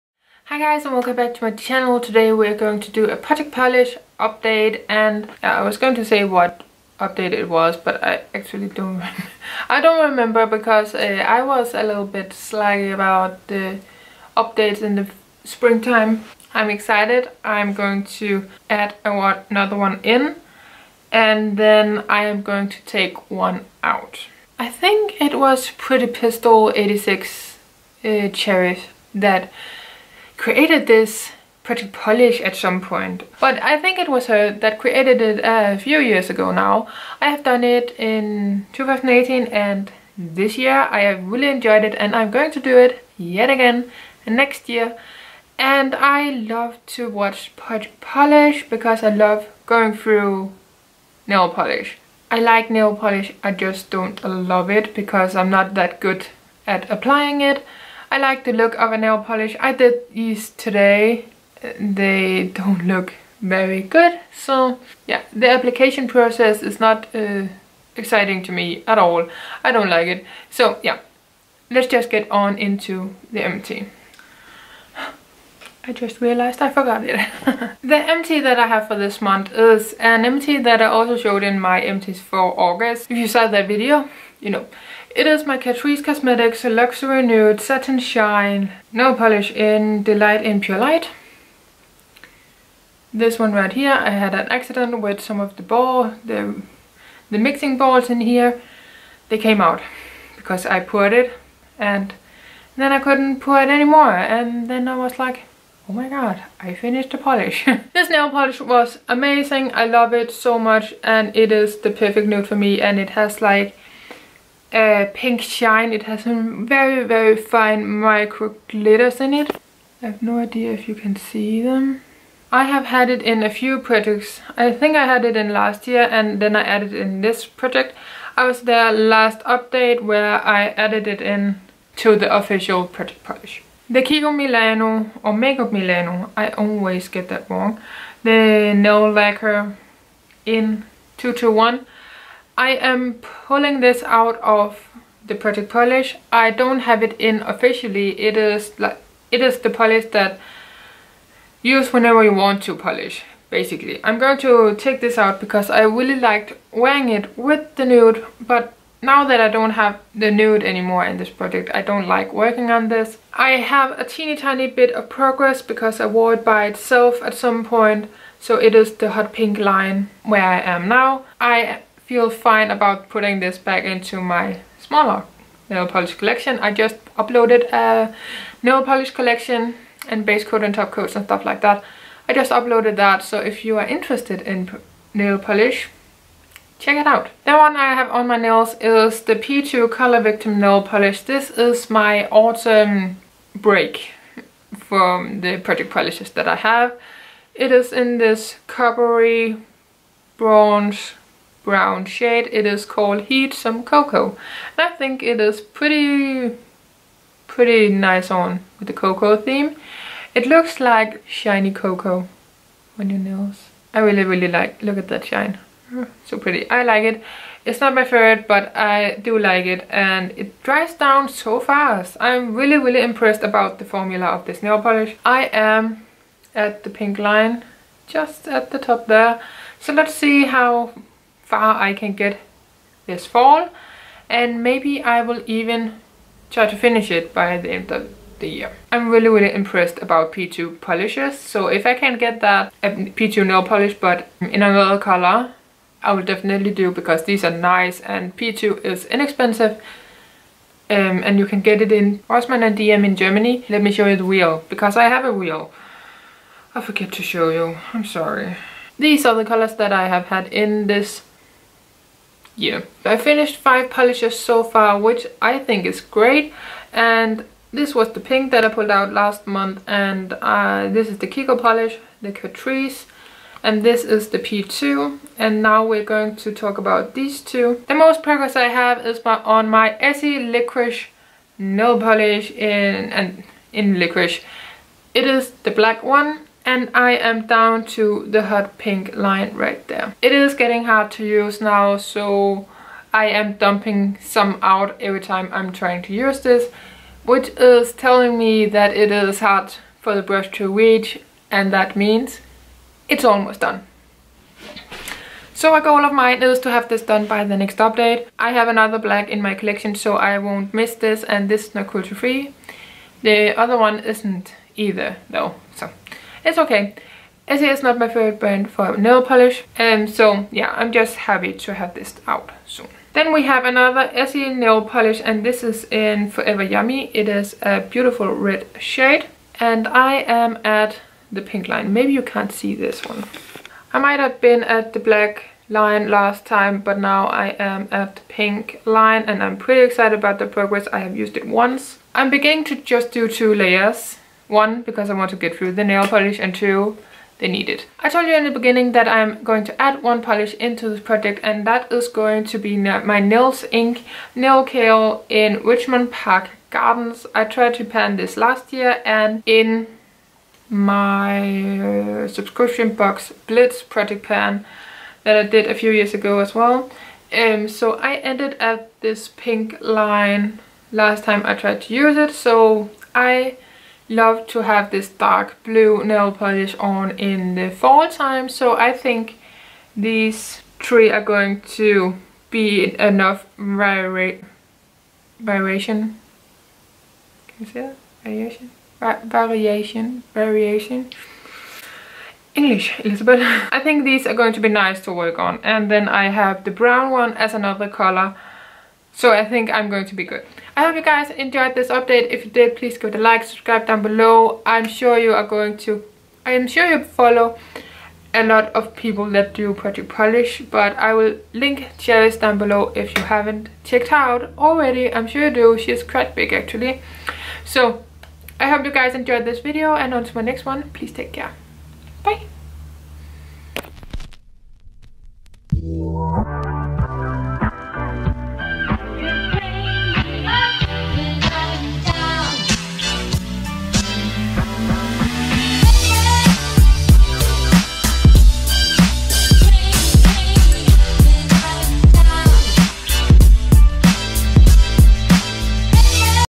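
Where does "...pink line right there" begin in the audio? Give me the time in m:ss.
4:48.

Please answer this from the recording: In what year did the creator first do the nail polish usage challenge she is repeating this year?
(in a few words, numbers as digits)
2018.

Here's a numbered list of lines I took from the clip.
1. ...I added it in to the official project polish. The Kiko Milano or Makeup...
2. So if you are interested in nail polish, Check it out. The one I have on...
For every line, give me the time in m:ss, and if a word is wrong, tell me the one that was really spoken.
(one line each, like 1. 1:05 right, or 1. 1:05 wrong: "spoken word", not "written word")
1. 2:10 right
2. 3:03 right.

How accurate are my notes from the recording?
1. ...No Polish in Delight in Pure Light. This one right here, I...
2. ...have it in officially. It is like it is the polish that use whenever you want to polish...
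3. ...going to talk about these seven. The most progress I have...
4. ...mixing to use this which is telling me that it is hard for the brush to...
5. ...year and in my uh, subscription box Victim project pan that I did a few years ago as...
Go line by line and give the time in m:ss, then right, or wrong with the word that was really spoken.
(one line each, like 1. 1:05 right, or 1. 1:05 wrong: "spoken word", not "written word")
1. 1:28 right
2. 2:26 right
3. 4:36 wrong: "two", not "seven"
4. 4:55 wrong: "trying", not "mixing"
5. 5:58 wrong: "Blitz", not "Victim".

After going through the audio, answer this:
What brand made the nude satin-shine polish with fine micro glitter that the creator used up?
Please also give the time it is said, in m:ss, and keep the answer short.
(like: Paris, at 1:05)
Catrice Cosmetics, at 1:25.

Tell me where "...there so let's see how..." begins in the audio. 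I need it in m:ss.
3:49.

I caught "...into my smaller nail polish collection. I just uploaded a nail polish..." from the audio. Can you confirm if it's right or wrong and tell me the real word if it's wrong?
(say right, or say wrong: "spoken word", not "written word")
right.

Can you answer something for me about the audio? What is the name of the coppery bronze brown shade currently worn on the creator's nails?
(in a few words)
Heat Some Cocoa.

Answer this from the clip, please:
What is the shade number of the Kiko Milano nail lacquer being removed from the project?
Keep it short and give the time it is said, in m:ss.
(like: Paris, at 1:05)
221, at 2:21.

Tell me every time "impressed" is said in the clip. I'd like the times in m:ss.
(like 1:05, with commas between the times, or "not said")
3:43, 3:59.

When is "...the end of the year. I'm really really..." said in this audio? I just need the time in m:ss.
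3:57.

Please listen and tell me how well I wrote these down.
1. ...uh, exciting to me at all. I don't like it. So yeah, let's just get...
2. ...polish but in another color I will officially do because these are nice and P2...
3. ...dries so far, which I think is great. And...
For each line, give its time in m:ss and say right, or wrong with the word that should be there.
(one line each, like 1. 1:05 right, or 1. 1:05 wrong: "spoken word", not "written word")
1. 1:07 right
2. 4:03 wrong: "definitely", not "officially"
3. 4:23 wrong: "polishes", not "dries".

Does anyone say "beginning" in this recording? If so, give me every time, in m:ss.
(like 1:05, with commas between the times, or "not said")
5:42, 5:48.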